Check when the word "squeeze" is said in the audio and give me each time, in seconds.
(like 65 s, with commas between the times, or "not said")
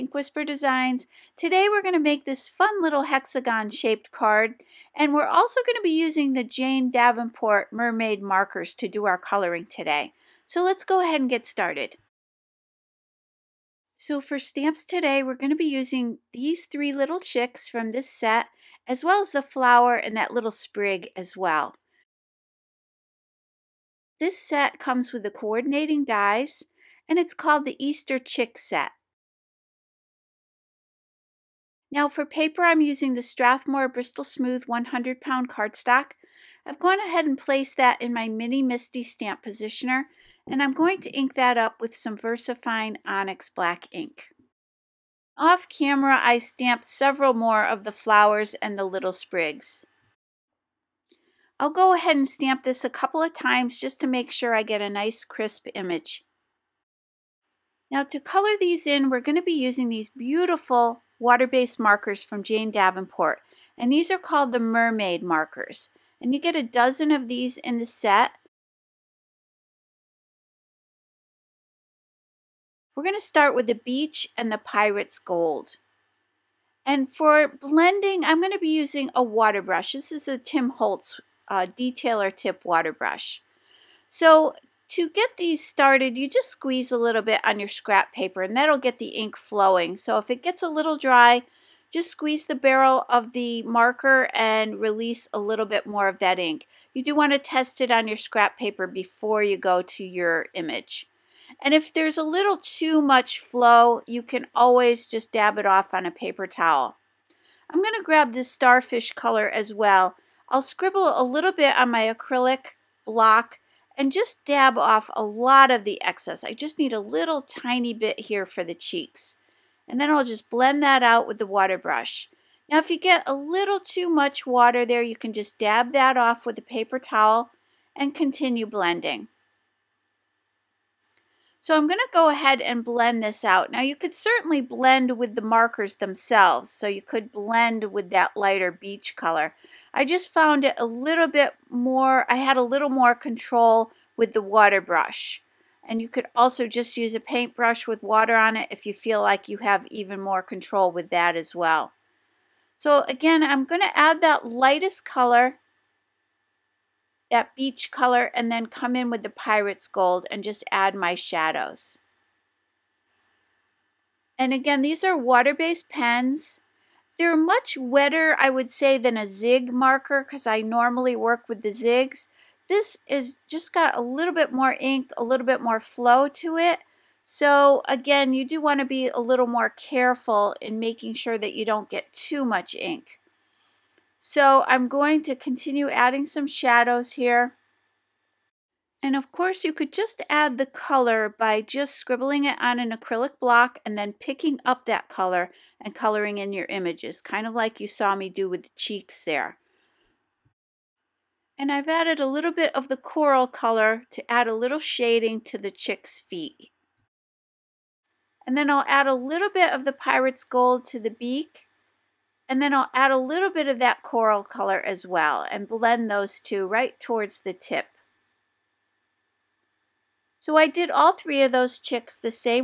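86 s, 92 s.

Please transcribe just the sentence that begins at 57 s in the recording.
Now to color these in, we're going to be using these beautiful water-based markers from Jane Davenport.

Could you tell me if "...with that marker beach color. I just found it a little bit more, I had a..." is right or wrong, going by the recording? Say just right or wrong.
wrong.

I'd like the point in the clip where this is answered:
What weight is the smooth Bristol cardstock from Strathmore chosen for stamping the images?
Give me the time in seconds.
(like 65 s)
34 s.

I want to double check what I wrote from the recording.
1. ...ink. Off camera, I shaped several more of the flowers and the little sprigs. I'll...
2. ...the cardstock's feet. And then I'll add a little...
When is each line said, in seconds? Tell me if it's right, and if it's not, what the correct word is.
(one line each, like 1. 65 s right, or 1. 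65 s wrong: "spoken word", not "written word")
1. 43 s wrong: "stamped", not "shaped"
2. 205 s wrong: "chick", not "cardstock".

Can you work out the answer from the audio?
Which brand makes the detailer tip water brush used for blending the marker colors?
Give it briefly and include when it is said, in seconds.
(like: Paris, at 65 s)
Tim Holtz, at 80 s.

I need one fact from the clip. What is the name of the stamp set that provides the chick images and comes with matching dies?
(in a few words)
Easter Chick Set.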